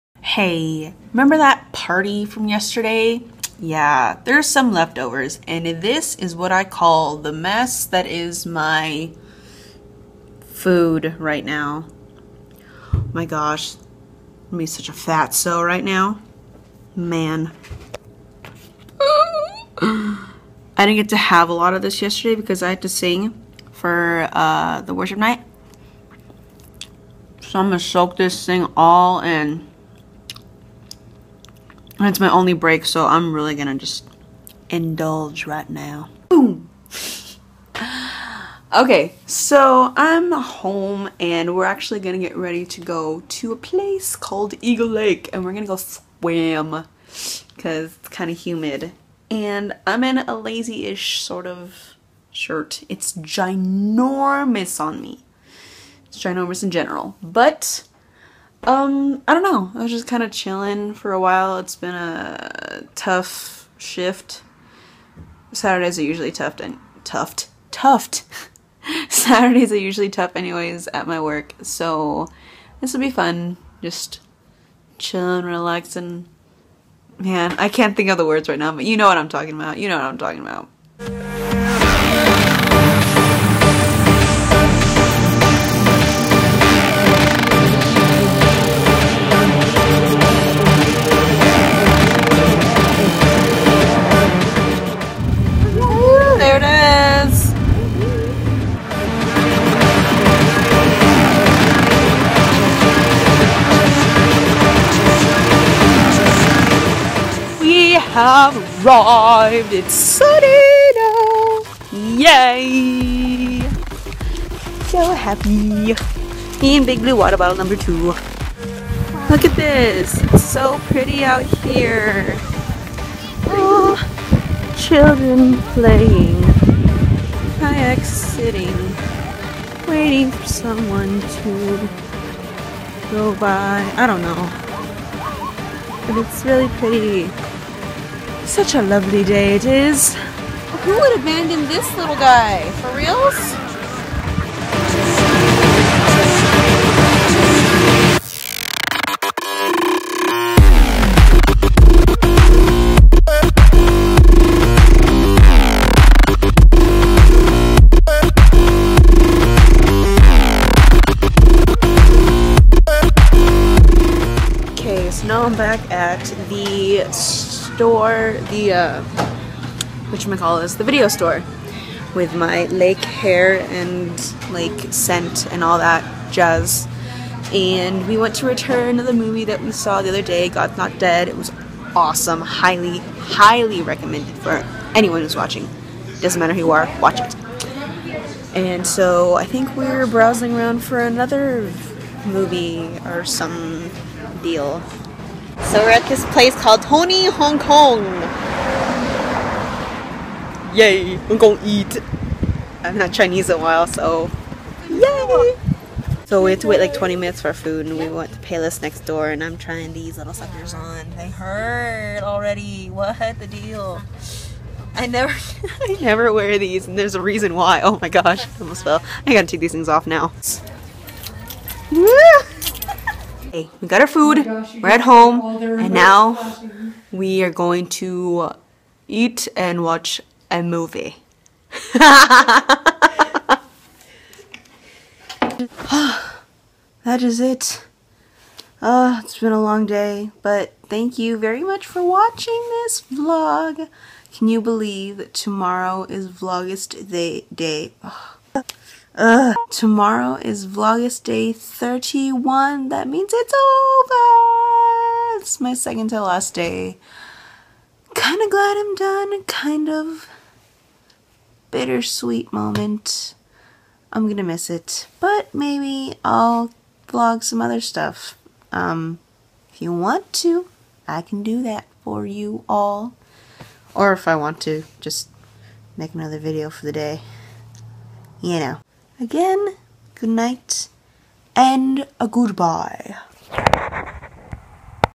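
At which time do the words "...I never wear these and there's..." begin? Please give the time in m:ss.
3:35.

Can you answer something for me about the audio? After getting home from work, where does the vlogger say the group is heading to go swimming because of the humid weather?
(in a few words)
Eagle Lake.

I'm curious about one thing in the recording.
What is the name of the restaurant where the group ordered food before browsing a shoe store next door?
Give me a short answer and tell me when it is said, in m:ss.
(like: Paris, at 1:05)
Tony Hong Kong, at 3:16.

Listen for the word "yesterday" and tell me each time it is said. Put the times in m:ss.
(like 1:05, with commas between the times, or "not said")
0:02, 0:22.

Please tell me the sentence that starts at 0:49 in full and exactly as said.
And I'm in a lazy-ish sort of shirt.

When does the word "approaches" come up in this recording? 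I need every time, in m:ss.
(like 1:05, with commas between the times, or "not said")
not said.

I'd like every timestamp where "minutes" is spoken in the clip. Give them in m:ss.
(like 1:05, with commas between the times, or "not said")
3:27.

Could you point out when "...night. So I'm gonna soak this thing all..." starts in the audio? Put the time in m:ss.
0:25.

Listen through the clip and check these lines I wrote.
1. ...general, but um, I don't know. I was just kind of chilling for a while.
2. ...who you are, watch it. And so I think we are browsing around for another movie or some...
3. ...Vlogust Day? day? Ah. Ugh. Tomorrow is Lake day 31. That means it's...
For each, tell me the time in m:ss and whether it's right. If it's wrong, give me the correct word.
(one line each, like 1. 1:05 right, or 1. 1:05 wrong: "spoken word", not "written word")
1. 0:56 right
2. 3:06 right
3. 4:06 wrong: "Vlogust", not "Lake".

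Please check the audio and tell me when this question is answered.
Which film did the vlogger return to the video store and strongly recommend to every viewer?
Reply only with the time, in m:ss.
3:00.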